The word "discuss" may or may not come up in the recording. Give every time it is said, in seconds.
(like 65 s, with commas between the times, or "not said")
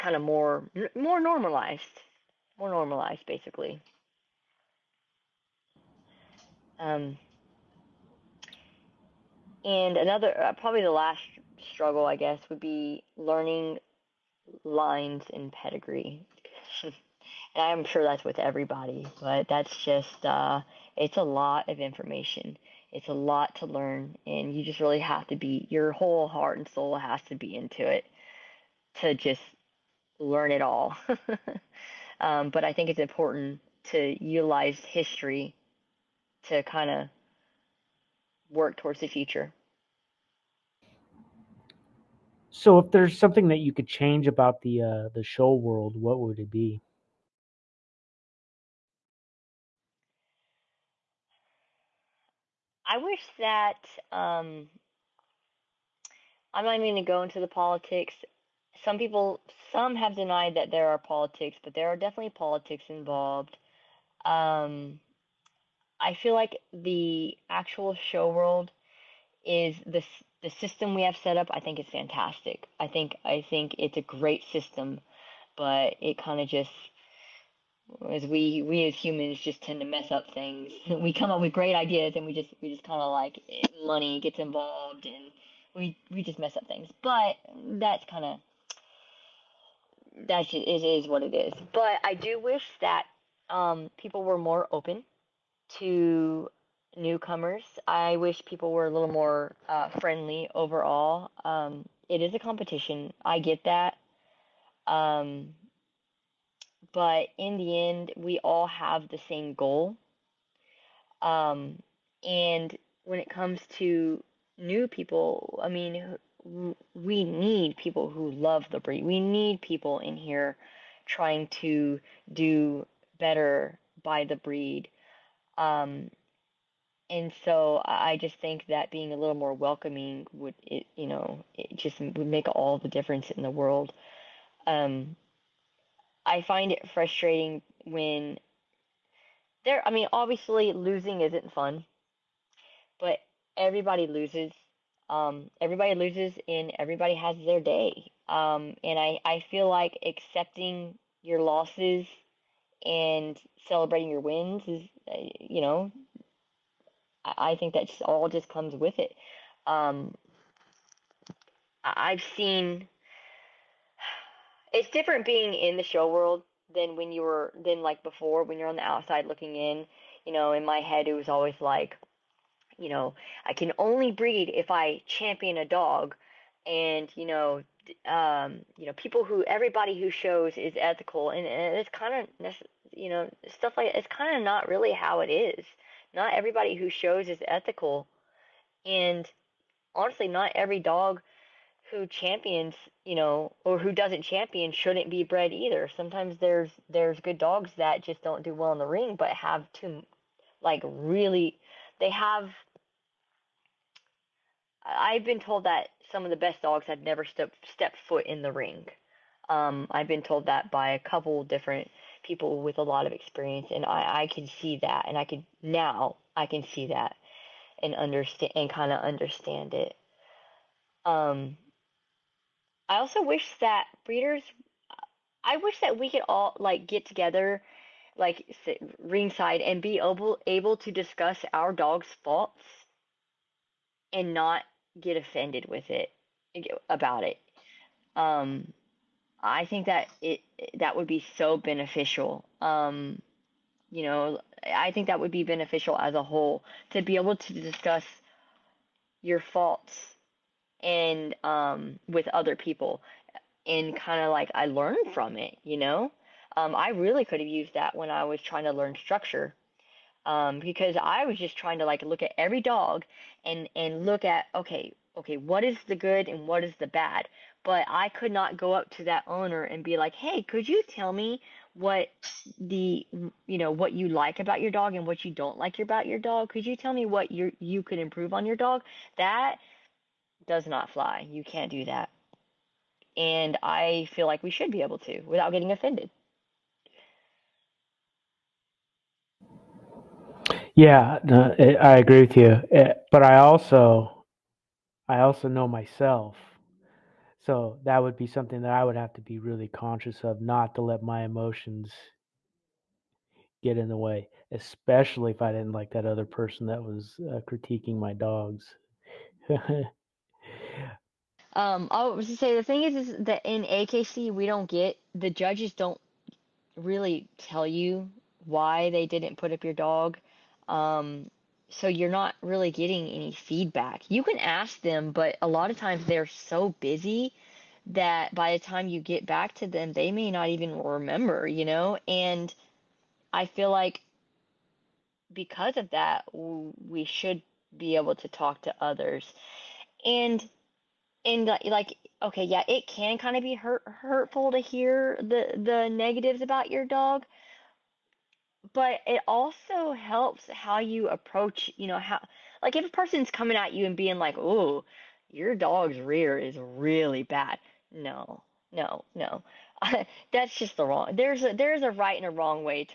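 230 s, 247 s.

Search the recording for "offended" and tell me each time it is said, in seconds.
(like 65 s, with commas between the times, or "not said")
235 s, 285 s.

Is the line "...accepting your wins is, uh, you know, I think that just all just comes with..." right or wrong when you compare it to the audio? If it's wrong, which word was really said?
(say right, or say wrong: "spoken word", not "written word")
wrong: "celebrating", not "accepting".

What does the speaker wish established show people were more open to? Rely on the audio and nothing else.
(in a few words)
Newcomers.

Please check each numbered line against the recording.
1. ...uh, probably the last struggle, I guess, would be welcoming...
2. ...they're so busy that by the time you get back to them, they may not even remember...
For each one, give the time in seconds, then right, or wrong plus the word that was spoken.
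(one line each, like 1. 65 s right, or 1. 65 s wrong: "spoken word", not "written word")
1. 10 s wrong: "learning", not "welcoming"
2. 326 s right.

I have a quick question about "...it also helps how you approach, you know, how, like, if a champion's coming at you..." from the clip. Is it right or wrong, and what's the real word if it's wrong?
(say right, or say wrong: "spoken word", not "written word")
wrong: "person", not "champion".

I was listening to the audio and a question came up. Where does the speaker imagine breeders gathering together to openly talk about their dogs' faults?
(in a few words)
Ringside.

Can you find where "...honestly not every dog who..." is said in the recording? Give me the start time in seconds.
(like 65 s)
189 s.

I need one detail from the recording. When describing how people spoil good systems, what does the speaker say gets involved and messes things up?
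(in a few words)
Money.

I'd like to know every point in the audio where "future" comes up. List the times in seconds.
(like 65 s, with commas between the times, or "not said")
39 s.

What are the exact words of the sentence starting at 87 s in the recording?
But that's kind of that's just, it is what it is.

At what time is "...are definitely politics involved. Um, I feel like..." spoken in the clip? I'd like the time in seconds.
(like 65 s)
61 s.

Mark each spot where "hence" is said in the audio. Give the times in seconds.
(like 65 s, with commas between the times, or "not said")
not said.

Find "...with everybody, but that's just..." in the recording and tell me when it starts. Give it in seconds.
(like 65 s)
18 s.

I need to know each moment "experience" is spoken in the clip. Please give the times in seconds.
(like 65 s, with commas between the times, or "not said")
213 s.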